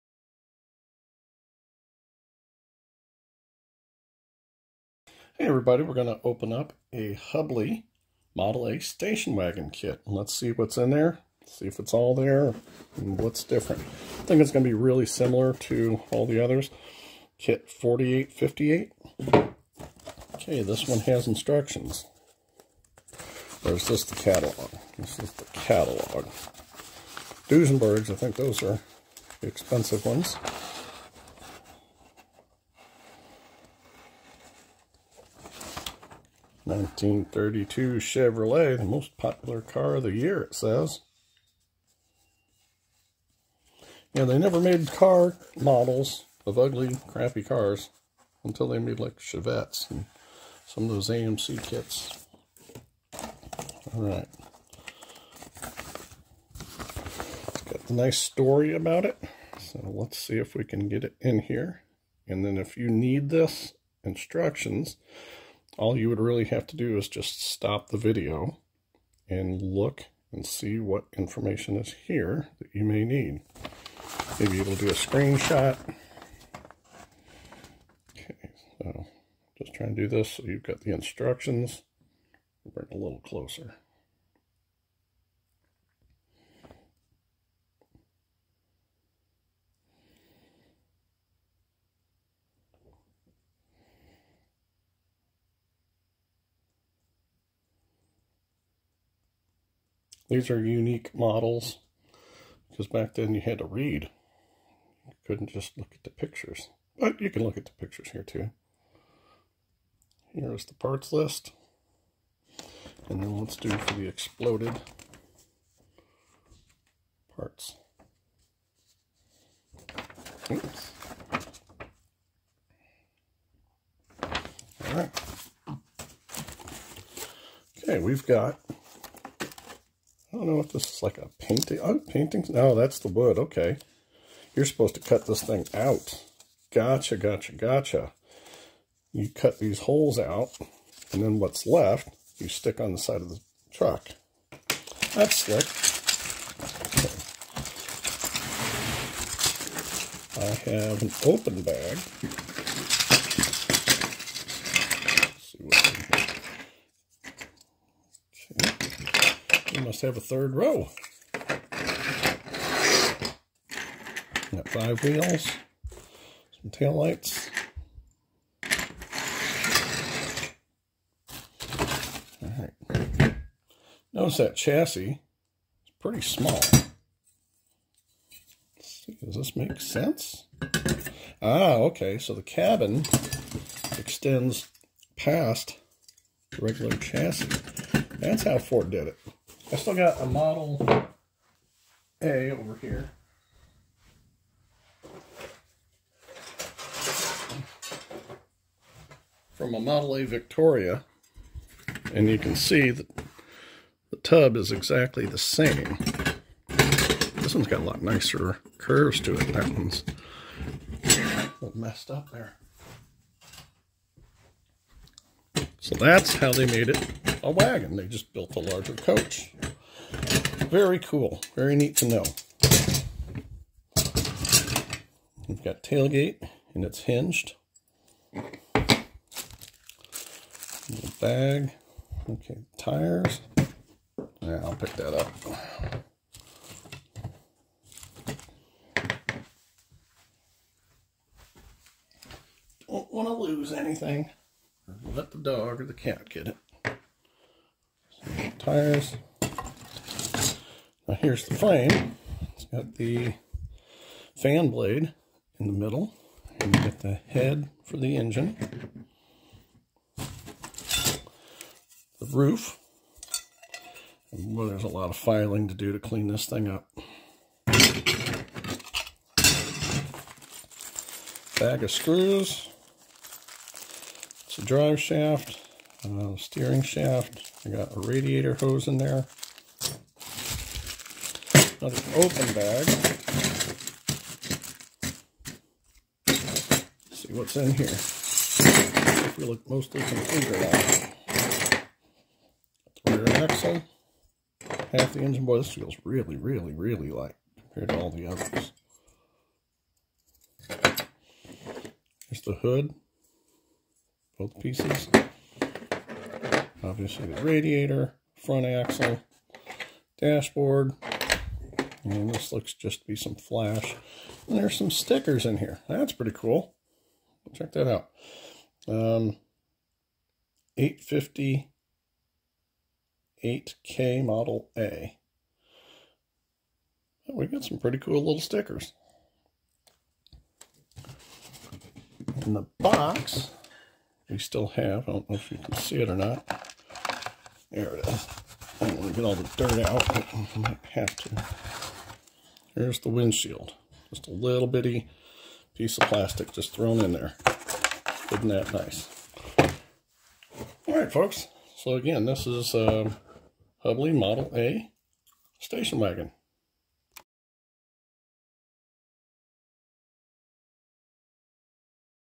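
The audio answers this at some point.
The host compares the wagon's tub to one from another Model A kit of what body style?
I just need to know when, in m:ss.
3:20.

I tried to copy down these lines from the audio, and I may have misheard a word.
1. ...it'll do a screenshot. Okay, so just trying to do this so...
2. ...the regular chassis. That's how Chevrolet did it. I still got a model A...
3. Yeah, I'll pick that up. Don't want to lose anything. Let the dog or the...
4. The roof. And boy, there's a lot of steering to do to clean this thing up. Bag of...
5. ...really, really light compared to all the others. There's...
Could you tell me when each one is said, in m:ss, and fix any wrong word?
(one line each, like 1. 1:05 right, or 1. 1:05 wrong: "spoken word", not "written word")
1. 1:14 right
2. 3:06 wrong: "Ford", not "Chevrolet"
3. 3:54 right
4. 4:20 wrong: "filing", not "steering"
5. 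4:56 right.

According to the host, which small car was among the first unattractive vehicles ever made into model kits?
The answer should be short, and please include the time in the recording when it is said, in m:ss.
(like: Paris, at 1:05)
Chevettes, at 0:49.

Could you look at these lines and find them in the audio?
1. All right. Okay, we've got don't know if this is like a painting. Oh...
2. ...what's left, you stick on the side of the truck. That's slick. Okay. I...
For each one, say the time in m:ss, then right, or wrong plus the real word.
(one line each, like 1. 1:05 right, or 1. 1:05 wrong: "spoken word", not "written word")
1. 2:04 right
2. 2:21 right.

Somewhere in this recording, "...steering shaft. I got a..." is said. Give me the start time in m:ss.
4:36.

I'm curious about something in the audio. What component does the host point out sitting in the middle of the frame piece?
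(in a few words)
fan blade.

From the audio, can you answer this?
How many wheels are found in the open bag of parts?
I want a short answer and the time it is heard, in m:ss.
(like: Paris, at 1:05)
5, at 2:44.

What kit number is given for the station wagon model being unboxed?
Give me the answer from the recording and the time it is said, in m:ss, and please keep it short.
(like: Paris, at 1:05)
4858, at 0:17.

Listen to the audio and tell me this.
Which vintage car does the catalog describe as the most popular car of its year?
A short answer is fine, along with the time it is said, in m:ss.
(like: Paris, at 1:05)
1932 Chevrolet, at 0:36.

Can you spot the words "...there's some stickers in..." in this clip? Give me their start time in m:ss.
5:14.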